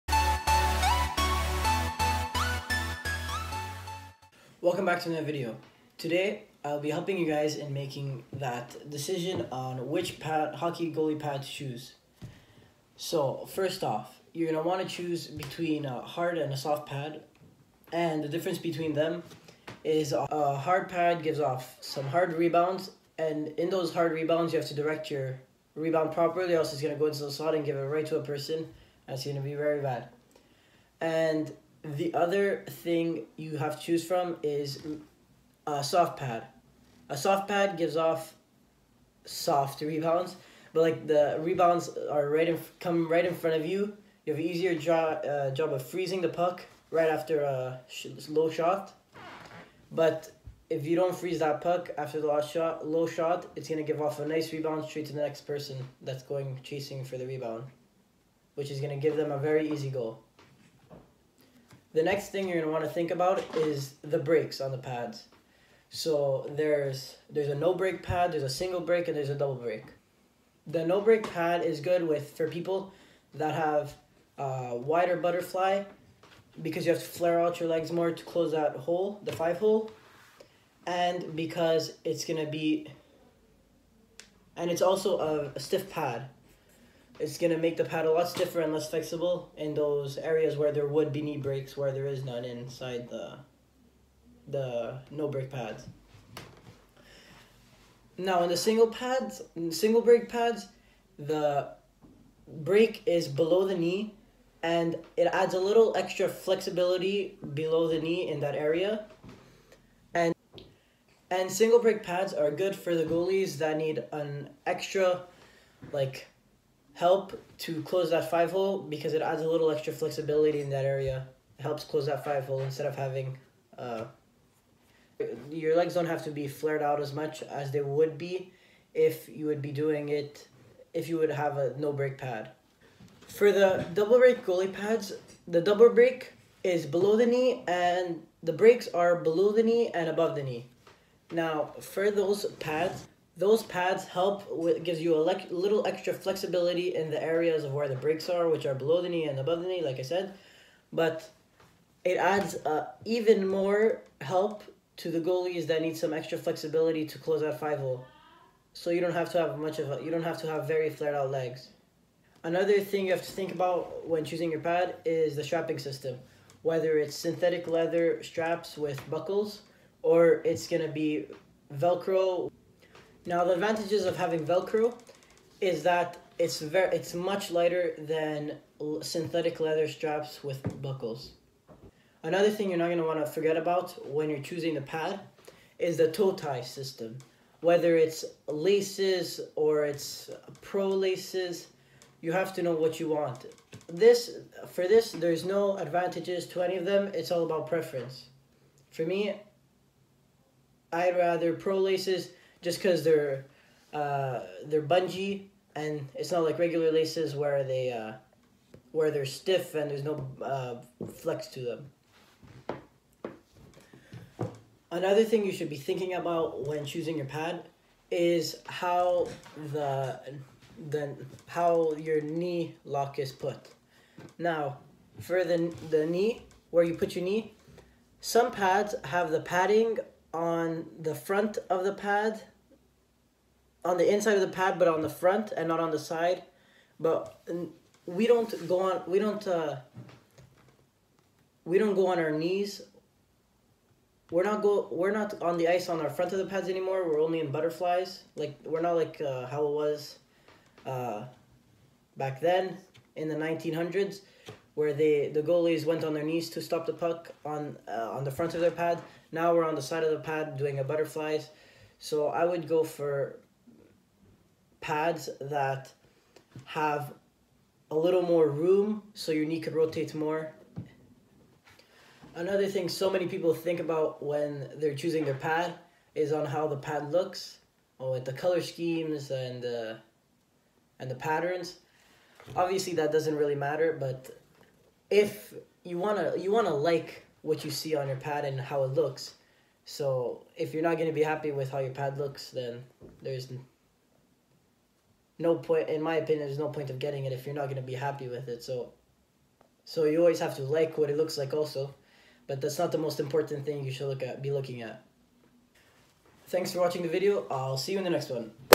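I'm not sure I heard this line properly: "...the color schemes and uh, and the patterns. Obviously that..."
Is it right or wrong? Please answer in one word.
right.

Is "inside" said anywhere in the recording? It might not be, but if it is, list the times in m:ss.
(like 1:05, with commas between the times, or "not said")
1:32, 3:54.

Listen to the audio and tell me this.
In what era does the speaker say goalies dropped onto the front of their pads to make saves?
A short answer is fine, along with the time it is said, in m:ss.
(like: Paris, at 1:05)
1900s, at 4:13.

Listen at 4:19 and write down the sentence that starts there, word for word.
Now we're on the side of the pad doing a butterflies.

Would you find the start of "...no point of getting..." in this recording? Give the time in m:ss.
4:56.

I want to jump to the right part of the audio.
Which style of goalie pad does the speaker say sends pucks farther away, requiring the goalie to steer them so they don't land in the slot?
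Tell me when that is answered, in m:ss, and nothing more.
0:20.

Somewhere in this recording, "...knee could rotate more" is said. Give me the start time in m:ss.
4:29.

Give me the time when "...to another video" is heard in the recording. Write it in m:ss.
0:05.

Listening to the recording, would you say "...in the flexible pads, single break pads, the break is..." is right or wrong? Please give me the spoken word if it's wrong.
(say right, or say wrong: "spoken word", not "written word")
wrong: "single", not "flexible".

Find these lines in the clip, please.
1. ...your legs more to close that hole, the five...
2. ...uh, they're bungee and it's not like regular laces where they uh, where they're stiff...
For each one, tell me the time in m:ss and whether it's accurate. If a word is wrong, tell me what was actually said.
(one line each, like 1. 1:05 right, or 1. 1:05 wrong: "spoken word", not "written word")
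1. 1:17 right
2. 3:23 right.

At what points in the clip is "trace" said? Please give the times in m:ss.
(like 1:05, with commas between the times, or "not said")
not said.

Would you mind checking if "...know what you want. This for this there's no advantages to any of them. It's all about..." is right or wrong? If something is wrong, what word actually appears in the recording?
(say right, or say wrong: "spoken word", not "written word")
right.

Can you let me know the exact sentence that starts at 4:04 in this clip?
We're not go, we're not on the ice on our front of the pads anymore.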